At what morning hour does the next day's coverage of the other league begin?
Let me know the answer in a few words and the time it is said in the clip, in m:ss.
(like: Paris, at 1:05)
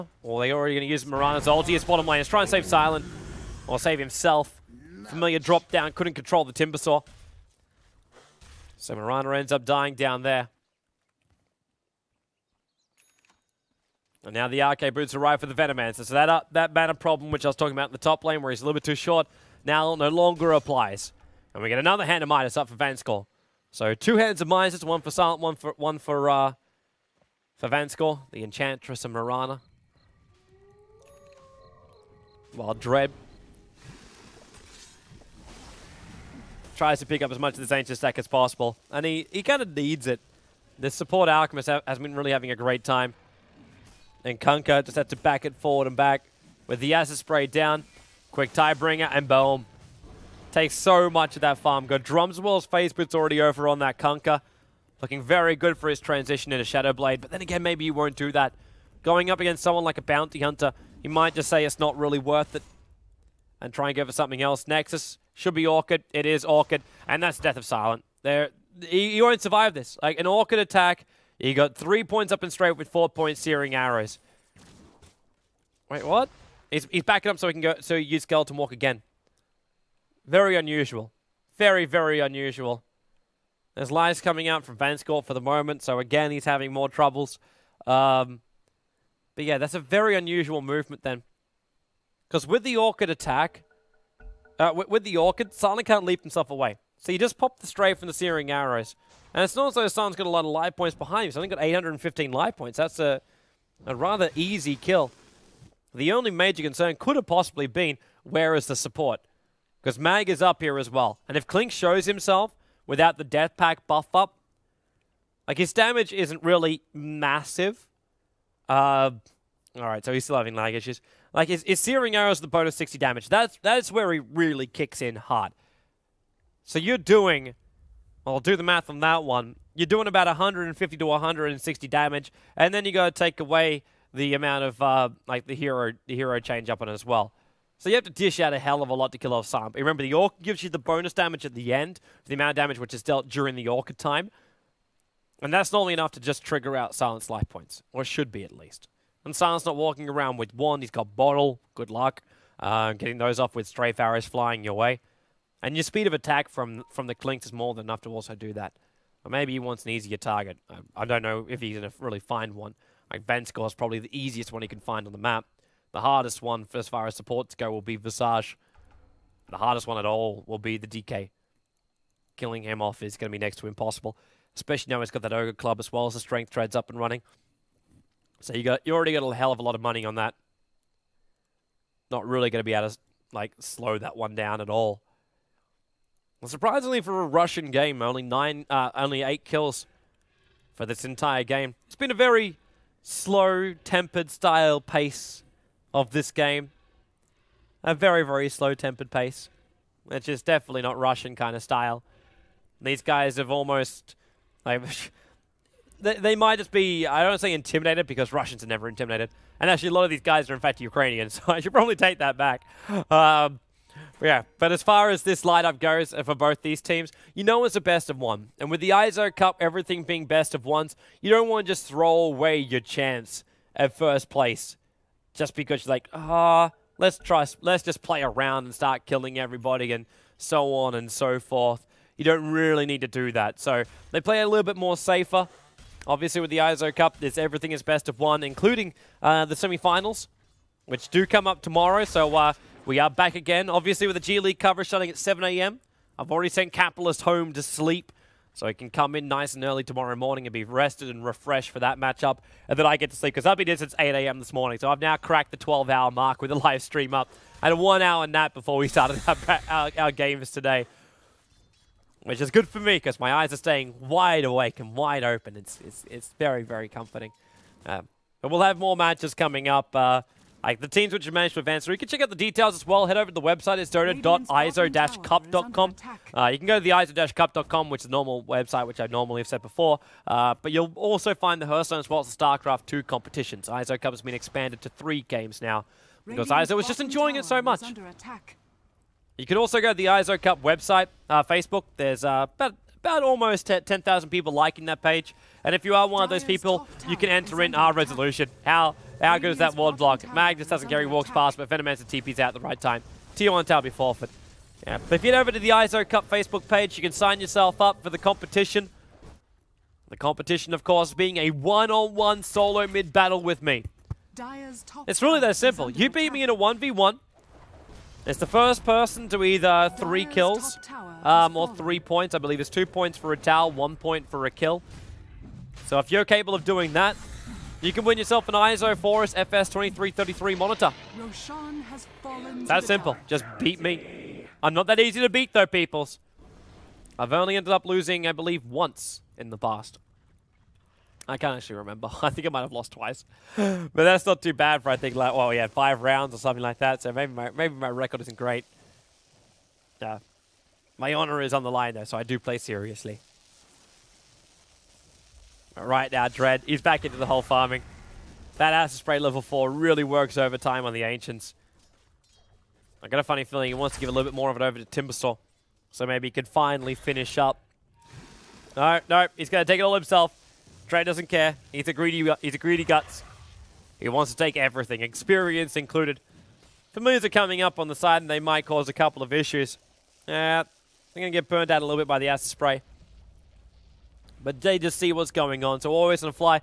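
7 a.m., at 4:05.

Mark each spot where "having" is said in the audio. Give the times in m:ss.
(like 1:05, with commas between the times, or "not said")
0:42, 1:26, 2:00.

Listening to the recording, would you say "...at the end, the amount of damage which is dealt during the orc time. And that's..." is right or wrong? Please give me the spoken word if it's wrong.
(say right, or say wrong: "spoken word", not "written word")
right.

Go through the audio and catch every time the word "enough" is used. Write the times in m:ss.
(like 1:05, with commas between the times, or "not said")
2:25, 2:37.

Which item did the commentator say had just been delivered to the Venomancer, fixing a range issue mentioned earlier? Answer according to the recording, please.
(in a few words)
Arcane boots.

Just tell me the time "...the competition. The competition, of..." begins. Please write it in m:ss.
5:08.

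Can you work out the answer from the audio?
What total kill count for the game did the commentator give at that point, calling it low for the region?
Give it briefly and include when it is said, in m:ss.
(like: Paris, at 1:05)
8, at 3:09.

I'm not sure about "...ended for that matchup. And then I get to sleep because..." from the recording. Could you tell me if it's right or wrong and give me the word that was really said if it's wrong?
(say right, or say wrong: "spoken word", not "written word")
wrong: "refreshed", not "ended".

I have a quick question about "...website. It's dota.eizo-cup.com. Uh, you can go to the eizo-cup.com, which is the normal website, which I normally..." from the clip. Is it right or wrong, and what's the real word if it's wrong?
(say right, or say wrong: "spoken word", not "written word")
right.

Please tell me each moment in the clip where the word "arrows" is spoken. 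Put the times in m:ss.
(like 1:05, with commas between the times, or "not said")
1:13, 1:38, 2:02, 2:33.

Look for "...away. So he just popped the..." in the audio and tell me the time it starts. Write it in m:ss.
1:36.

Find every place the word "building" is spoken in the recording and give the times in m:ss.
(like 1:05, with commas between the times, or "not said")
not said.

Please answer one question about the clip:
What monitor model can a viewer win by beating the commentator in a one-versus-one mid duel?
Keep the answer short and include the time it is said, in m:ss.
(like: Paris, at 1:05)
EIZO Foris FS2333, at 5:28.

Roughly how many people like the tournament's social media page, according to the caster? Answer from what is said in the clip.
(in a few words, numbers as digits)
almost 10,000.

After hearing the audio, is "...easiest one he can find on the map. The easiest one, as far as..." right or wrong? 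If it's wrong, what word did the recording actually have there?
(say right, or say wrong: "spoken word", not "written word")
wrong: "hardest", not "easiest".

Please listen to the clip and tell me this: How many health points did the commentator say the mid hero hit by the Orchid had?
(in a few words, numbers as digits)
815.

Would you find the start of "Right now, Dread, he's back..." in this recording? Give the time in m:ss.
5:55.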